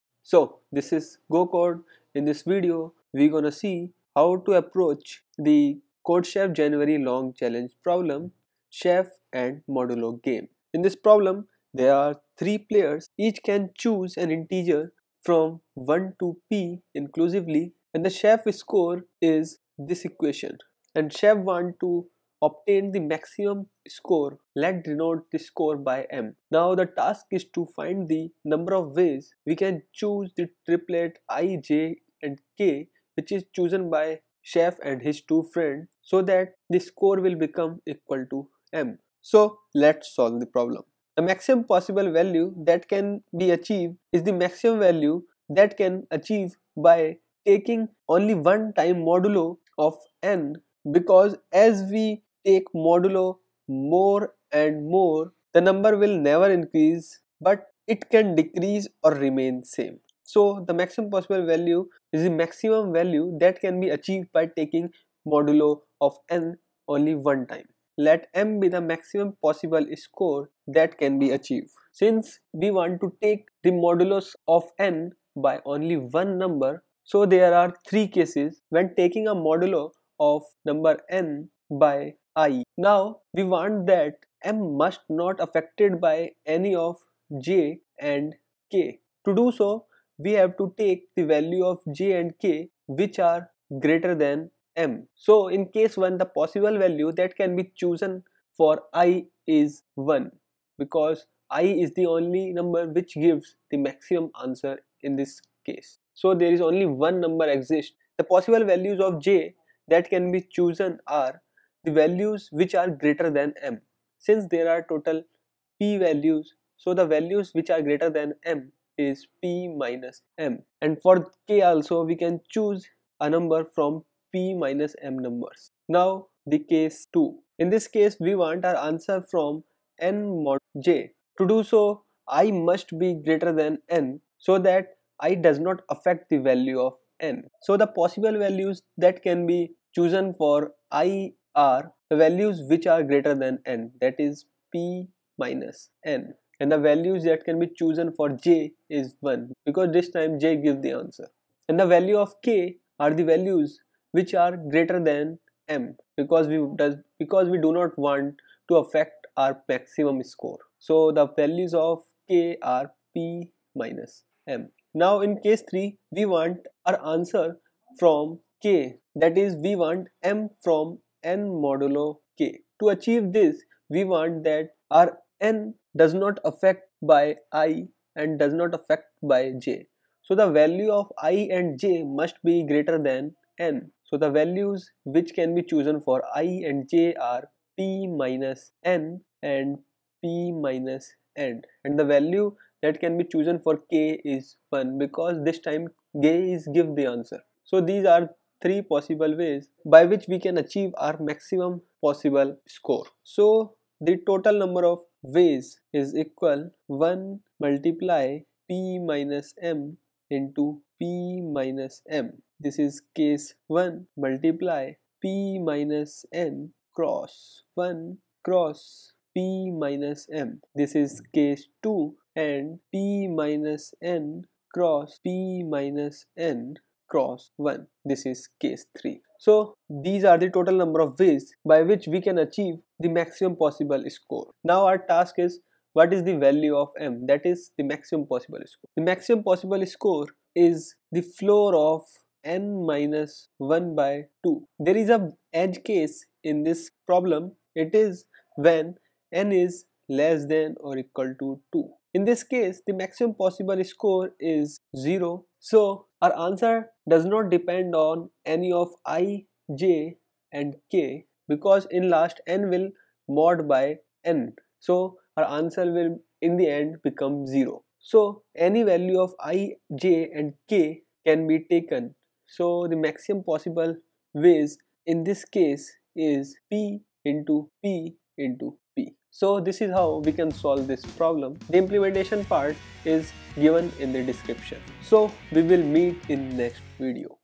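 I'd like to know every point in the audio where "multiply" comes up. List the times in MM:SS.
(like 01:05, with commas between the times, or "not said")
03:27, 03:34.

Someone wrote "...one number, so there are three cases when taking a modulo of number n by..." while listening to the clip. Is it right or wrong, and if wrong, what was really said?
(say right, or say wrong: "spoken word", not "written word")
right.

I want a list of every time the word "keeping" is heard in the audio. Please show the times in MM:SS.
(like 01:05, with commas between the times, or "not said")
not said.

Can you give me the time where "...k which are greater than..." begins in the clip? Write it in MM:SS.
01:32.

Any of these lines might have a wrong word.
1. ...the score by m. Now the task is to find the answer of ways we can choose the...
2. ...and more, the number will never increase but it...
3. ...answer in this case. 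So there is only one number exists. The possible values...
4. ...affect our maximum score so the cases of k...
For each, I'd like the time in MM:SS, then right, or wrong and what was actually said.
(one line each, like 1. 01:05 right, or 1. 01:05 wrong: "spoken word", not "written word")
1. 00:25 wrong: "number", not "answer"
2. 00:54 right
3. 01:44 right
4. 02:38 wrong: "values", not "cases".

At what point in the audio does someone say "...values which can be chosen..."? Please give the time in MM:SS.
03:04.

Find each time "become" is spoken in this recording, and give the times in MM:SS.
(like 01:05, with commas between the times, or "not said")
00:37, 04:27.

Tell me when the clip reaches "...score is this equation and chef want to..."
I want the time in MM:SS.
00:18.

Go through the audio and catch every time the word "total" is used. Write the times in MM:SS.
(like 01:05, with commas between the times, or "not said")
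01:54, 03:24, 03:50.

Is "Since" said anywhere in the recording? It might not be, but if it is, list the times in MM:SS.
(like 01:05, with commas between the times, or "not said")
01:11, 01:54.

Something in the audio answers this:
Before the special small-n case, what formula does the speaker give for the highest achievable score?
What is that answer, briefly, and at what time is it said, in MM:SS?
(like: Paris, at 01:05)
floor of (n-1)/2, at 04:01.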